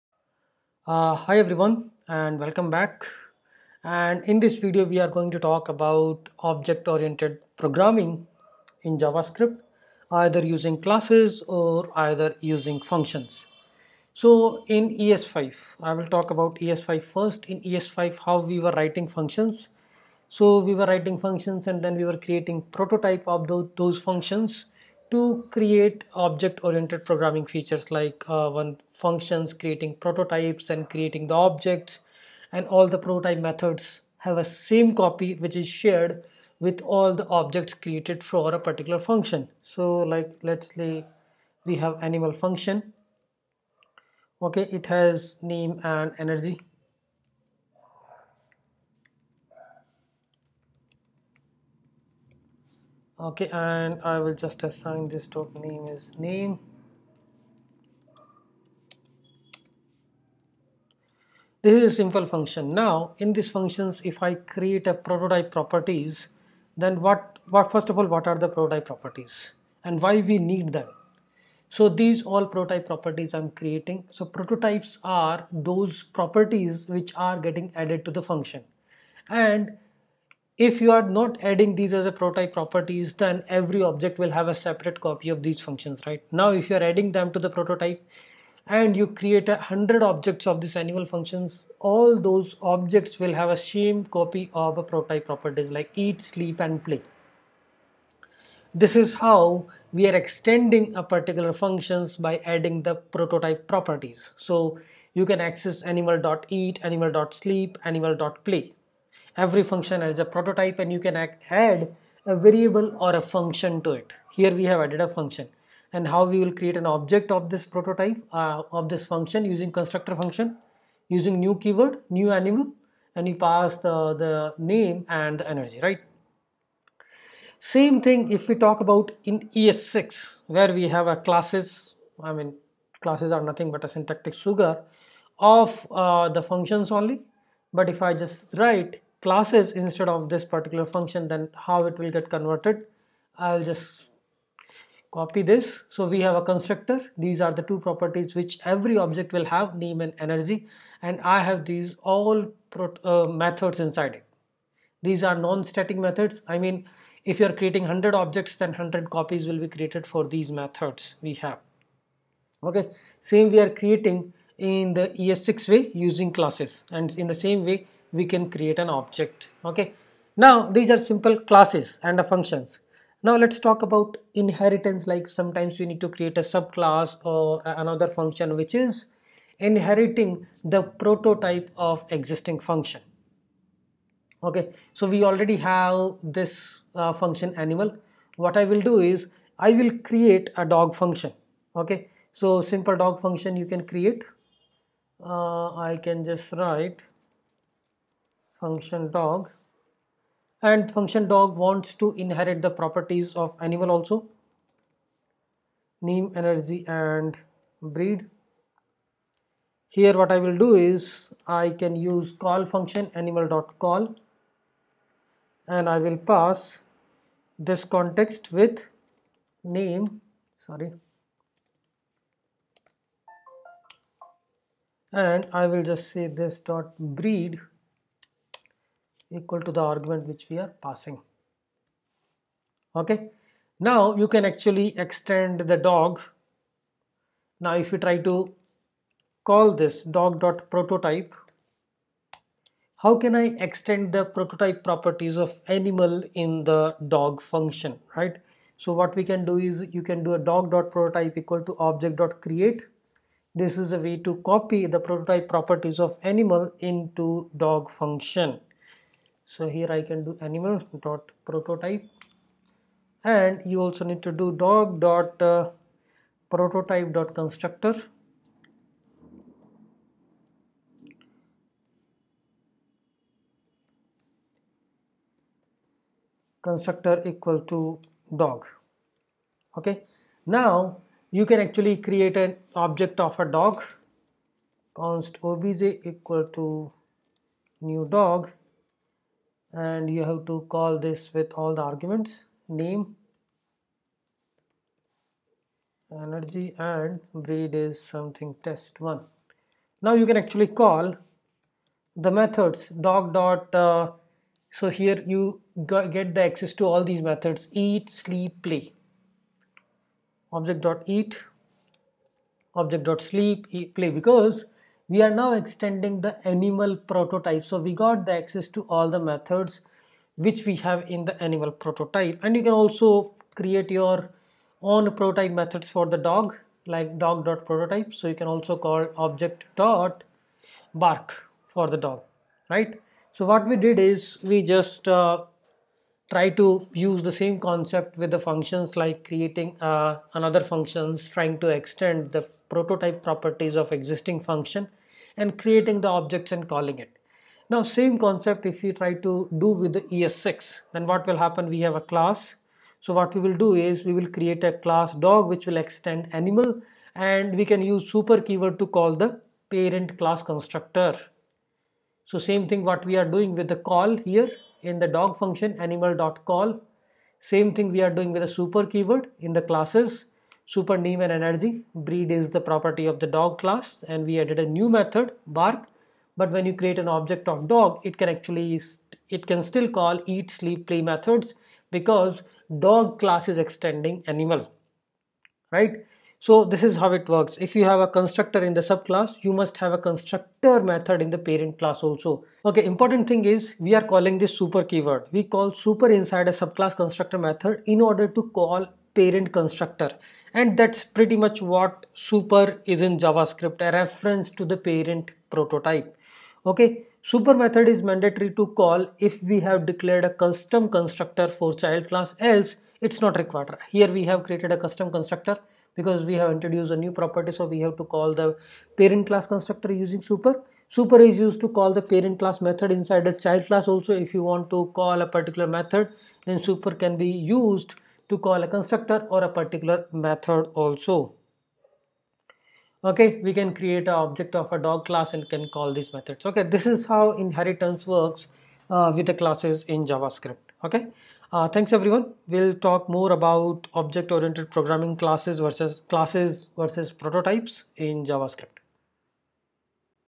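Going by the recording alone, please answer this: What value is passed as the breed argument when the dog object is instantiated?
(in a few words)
test one.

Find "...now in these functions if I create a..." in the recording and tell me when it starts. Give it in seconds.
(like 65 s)
62 s.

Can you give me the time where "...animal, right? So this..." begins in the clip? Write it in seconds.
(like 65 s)
384 s.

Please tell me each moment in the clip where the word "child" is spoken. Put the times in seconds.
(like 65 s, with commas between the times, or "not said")
411 s, 423 s.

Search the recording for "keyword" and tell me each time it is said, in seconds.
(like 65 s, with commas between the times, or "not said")
121 s, 358 s, 368 s, 394 s.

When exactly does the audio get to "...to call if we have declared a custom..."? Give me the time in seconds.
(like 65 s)
408 s.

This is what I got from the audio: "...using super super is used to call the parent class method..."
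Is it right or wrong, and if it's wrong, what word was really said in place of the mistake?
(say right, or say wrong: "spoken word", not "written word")
right.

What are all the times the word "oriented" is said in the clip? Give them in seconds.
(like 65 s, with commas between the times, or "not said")
6 s, 26 s, 444 s.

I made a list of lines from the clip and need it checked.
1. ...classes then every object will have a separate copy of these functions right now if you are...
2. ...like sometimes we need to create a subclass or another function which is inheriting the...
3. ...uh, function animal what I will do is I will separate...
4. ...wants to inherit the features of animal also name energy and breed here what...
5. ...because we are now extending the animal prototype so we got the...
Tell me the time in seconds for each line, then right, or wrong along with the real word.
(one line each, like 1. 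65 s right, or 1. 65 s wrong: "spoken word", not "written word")
1. 82 s wrong: "properties", not "classes"
2. 175 s right
3. 186 s wrong: "create", not "separate"
4. 201 s wrong: "properties", not "features"
5. 314 s right.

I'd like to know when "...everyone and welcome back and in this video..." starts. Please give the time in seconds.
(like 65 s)
1 s.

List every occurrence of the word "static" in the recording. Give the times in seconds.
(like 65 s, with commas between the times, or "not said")
155 s.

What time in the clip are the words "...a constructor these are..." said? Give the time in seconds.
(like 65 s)
146 s.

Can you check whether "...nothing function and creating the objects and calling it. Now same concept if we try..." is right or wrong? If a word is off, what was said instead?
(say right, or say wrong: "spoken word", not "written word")
wrong: "existing", not "nothing".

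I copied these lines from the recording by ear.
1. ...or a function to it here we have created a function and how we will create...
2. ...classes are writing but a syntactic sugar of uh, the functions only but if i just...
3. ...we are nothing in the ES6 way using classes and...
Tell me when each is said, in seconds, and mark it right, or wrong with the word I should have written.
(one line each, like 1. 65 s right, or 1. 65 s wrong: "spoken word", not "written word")
1. 112 s wrong: "added", not "created"
2. 133 s wrong: "nothing", not "writing"
3. 163 s wrong: "creating", not "nothing".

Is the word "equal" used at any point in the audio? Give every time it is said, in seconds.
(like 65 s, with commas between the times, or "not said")
229 s, 251 s, 277 s, 286 s.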